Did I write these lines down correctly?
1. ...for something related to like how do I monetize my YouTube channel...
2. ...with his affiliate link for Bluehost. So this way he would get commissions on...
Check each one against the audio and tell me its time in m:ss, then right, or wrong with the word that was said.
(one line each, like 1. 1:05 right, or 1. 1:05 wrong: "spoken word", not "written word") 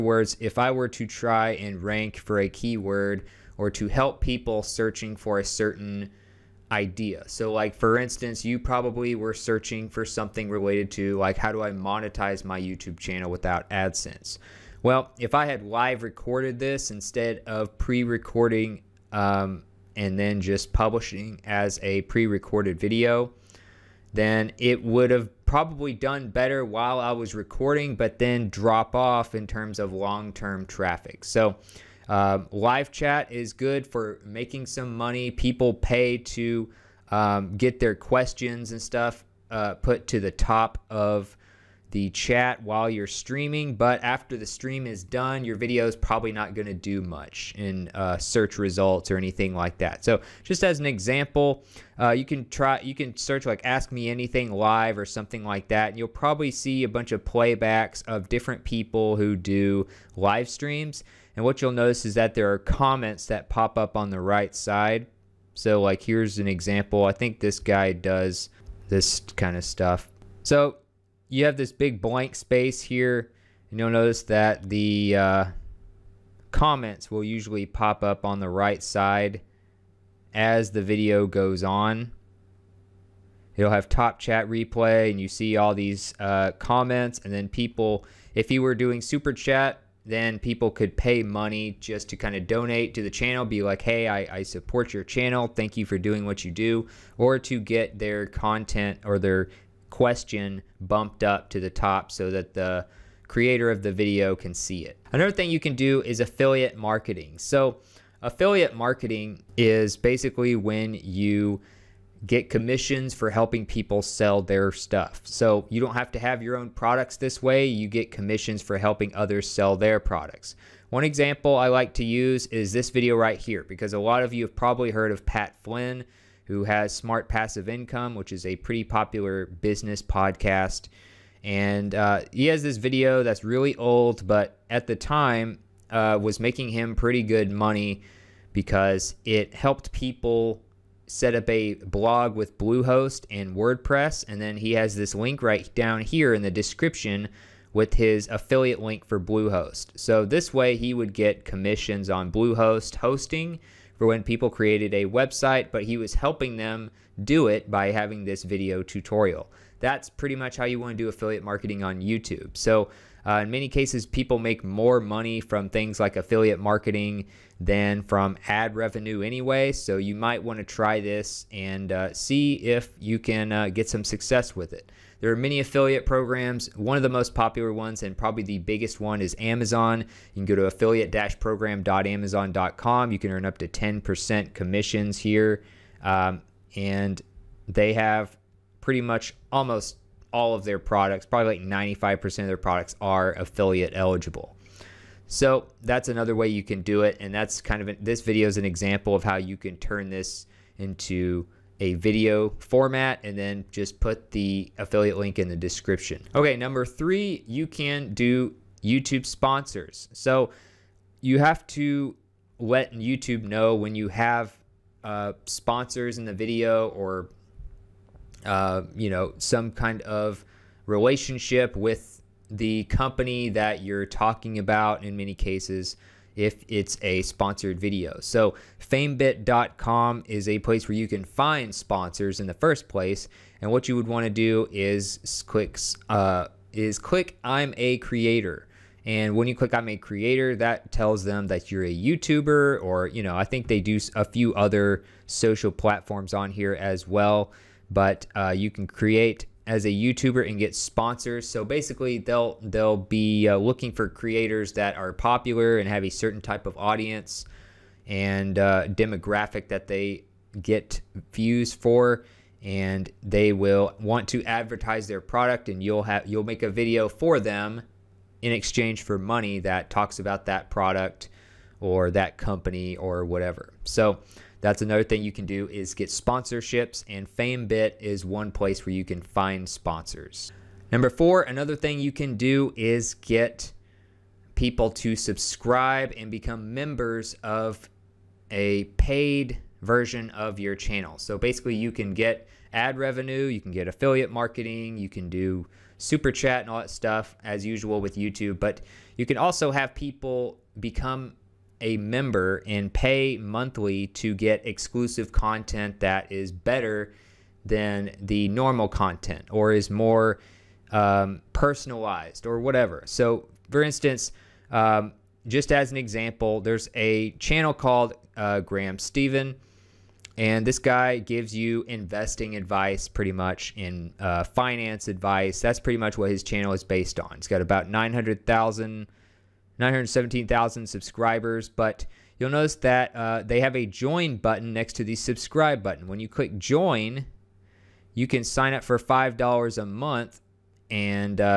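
1. 0:09 right
2. 2:27 right.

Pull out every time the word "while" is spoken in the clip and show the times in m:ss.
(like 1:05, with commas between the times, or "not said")
0:26, 0:42.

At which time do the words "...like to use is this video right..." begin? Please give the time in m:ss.
2:01.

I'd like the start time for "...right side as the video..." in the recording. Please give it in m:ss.
1:18.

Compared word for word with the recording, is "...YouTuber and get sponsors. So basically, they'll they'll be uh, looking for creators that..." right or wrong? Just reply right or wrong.
right.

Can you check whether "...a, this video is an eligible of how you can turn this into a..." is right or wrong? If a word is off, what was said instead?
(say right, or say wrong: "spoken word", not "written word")
wrong: "example", not "eligible".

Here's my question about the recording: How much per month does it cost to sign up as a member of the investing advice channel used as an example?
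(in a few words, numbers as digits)
$5.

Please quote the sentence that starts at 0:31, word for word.
So um, live chat is good for making some money.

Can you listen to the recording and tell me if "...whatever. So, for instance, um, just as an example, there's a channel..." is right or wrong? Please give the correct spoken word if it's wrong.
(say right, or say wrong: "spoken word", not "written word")
right.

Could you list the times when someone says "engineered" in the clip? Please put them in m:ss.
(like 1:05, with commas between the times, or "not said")
not said.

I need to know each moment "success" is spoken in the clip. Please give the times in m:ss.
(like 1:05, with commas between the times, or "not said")
2:54.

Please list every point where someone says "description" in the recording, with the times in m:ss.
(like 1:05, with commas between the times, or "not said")
2:26, 3:25.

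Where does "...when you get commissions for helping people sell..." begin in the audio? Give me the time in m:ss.
1:50.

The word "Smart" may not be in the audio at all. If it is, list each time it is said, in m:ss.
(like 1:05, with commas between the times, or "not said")
2:06.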